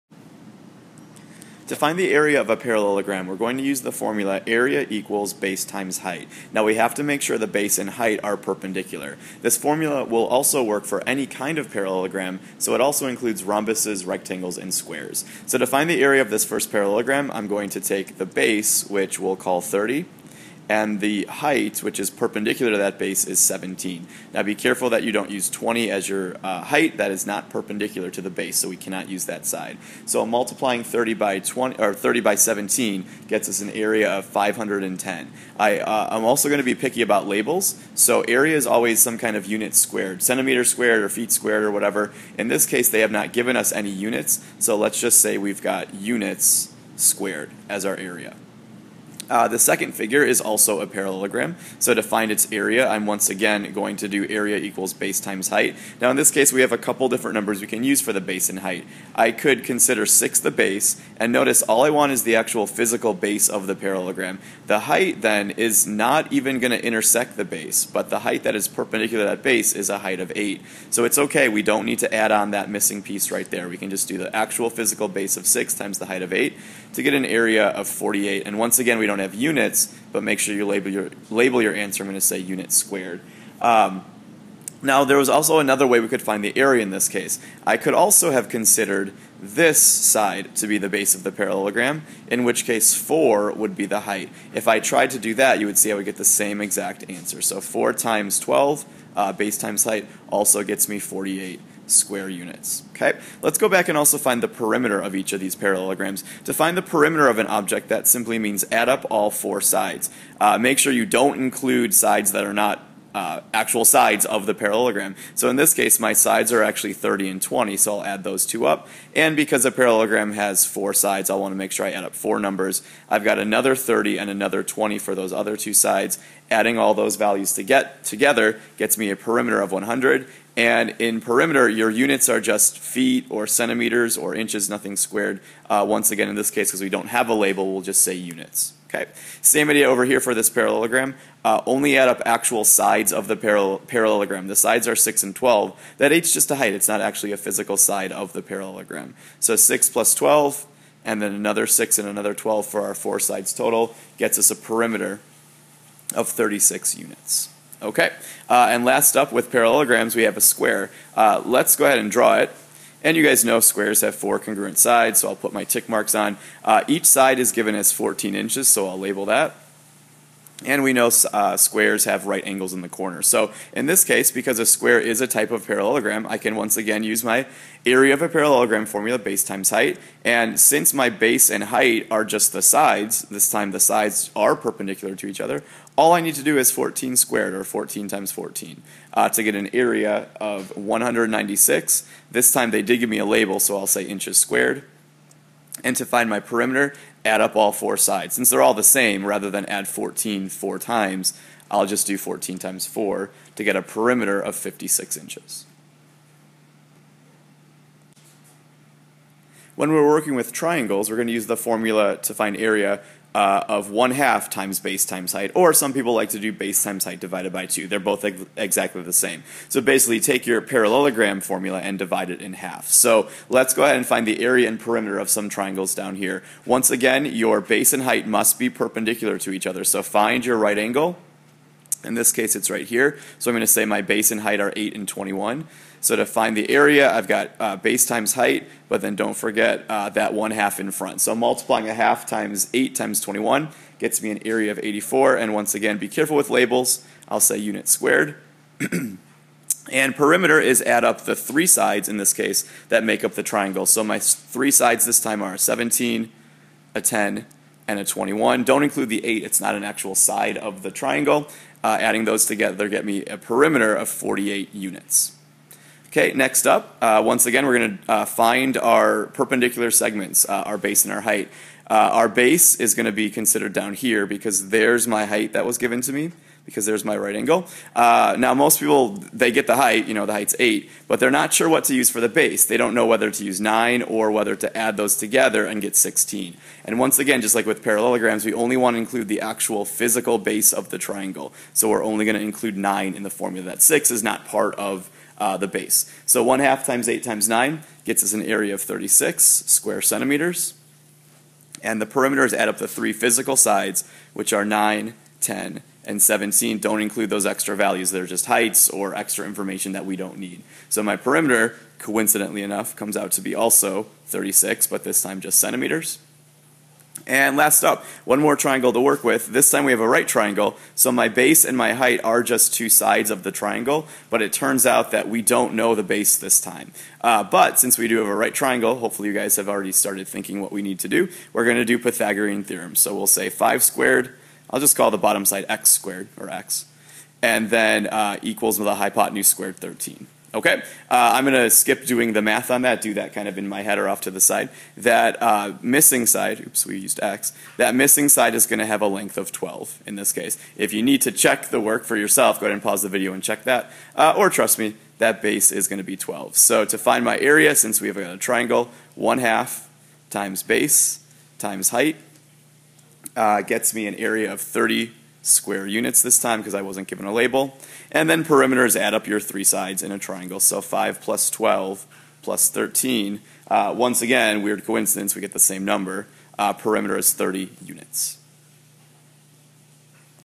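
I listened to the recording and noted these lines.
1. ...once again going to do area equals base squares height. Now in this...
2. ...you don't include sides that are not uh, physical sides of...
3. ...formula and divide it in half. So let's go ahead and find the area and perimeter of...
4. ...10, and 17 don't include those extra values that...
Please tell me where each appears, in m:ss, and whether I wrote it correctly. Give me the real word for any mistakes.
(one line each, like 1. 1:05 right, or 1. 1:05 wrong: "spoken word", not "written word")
1. 0:53 wrong: "times", not "squares"
2. 1:50 wrong: "actual", not "physical"
3. 3:41 right
4. 5:05 right.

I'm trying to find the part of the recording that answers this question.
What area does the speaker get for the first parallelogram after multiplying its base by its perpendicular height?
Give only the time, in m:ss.
0:34.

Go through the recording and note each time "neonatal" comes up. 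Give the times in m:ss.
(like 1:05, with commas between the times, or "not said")
not said.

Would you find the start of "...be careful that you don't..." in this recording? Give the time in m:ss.
0:24.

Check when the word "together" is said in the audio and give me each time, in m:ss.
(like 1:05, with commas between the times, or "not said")
2:08, 4:22, 4:45.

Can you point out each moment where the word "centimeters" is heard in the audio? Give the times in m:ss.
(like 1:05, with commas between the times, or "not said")
0:40, 2:13, 5:00, 5:15.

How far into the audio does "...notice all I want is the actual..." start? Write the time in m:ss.
1:01.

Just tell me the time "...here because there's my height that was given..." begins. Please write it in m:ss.
4:33.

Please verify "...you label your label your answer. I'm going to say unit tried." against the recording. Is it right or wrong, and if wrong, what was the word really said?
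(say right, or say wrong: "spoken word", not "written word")
wrong: "squared", not "tried".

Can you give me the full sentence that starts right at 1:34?
If I tried to do that, you would see I would get the same exact answer.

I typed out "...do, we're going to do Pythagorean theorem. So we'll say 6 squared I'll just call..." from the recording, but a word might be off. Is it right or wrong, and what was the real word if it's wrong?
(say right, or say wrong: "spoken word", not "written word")
wrong: "5", not "6".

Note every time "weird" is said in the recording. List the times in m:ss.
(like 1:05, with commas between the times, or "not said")
6:14.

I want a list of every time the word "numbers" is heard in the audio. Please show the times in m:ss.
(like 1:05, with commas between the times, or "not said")
0:57, 2:02, 6:15.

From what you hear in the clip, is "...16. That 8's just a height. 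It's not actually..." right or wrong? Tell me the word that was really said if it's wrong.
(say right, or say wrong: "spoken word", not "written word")
wrong: "12", not "16".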